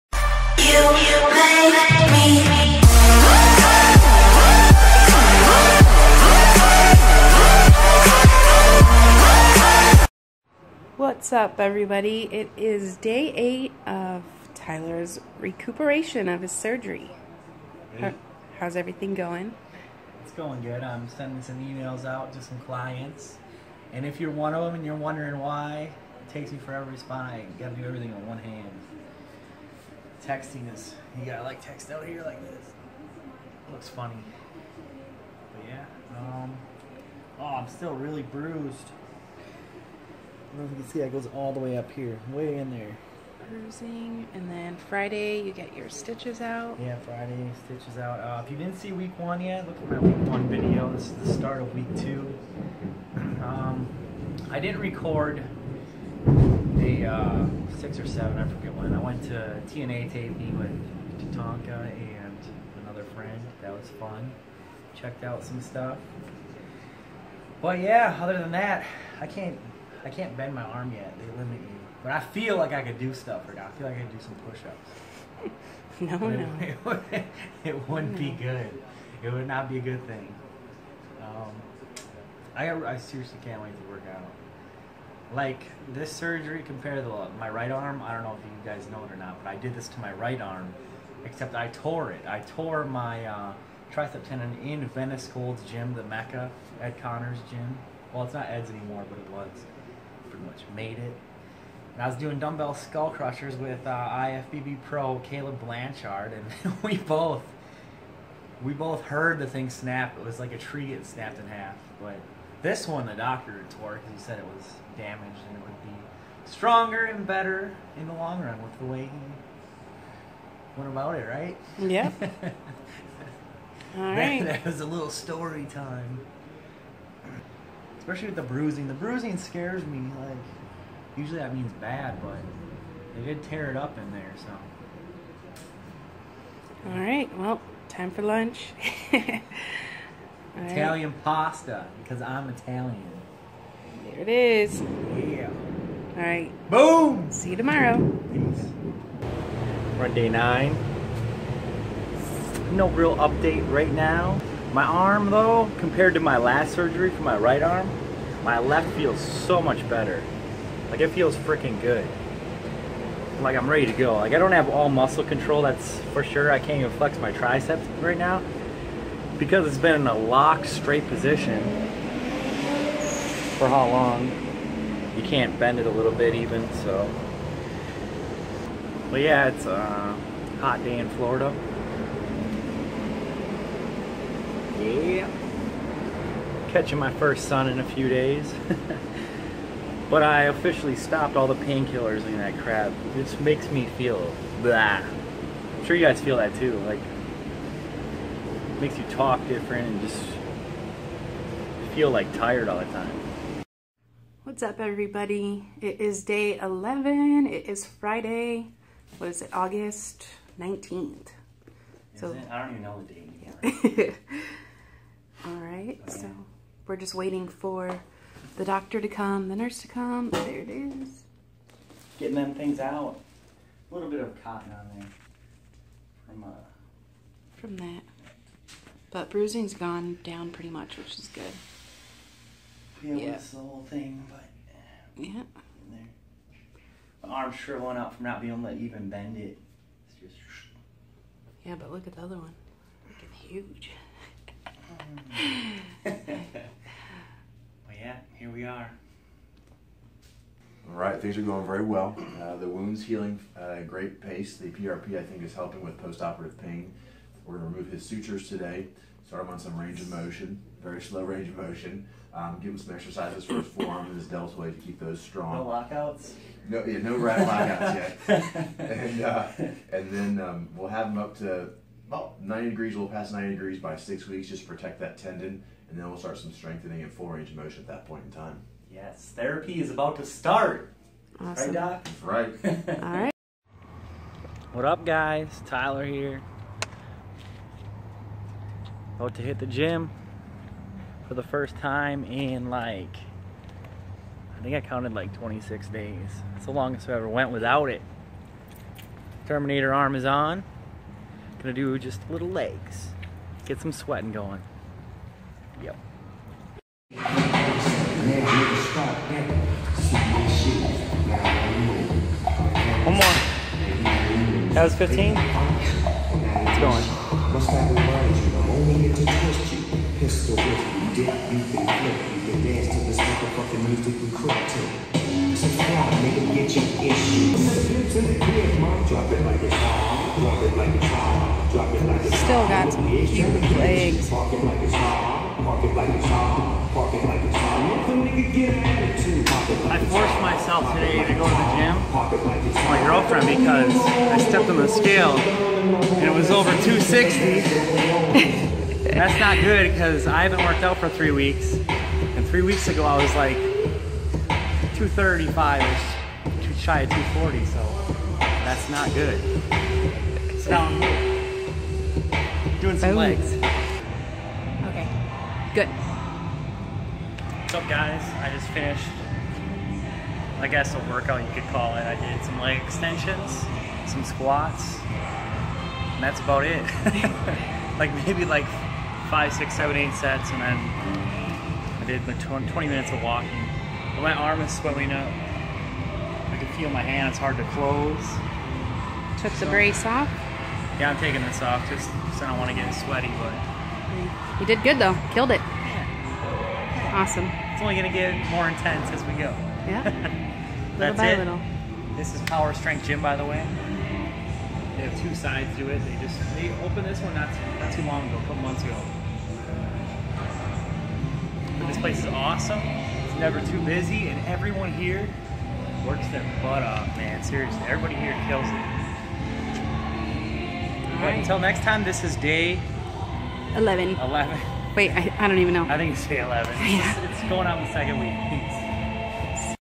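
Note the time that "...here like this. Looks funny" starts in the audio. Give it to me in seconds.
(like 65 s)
32 s.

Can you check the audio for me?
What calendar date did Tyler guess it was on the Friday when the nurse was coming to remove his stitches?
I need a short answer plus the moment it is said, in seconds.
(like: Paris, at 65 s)
August 19th, at 209 s.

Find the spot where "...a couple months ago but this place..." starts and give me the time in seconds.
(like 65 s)
408 s.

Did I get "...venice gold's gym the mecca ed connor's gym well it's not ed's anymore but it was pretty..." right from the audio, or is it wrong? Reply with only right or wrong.
right.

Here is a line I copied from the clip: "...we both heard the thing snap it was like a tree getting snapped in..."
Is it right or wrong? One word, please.
right.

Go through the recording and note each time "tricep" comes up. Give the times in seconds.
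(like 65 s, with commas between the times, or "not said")
93 s, 167 s.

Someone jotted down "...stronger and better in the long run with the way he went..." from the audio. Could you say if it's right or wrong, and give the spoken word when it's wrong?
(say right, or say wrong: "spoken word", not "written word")
right.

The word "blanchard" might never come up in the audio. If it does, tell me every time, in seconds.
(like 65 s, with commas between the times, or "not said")
105 s.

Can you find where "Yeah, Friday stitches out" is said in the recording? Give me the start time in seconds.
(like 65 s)
46 s.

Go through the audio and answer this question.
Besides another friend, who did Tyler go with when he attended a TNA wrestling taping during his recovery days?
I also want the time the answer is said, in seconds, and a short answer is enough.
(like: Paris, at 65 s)
Tatanka, at 61 s.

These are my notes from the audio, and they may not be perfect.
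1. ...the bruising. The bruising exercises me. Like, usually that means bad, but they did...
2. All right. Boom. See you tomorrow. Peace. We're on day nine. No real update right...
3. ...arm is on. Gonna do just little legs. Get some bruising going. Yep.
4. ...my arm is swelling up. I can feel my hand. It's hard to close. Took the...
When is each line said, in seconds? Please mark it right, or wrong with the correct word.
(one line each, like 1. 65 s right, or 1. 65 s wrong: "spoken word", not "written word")
1. 128 s wrong: "scares", not "exercises"
2. 146 s right
3. 299 s wrong: "sweating", not "bruising"
4. 384 s right.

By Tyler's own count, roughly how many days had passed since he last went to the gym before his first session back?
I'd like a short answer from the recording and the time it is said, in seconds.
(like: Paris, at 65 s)
26, at 295 s.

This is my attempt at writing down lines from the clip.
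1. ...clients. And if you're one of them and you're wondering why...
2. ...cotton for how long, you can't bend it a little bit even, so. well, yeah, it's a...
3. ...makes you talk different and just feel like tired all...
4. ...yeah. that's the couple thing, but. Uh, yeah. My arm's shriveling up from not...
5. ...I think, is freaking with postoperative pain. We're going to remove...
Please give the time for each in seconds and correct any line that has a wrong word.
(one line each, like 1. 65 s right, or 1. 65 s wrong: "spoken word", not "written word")
1. 22 s right
2. 171 s wrong: "position", not "cotton"
3. 198 s right
4. 233 s wrong: "whole", not "couple"
5. 255 s wrong: "helping", not "freaking".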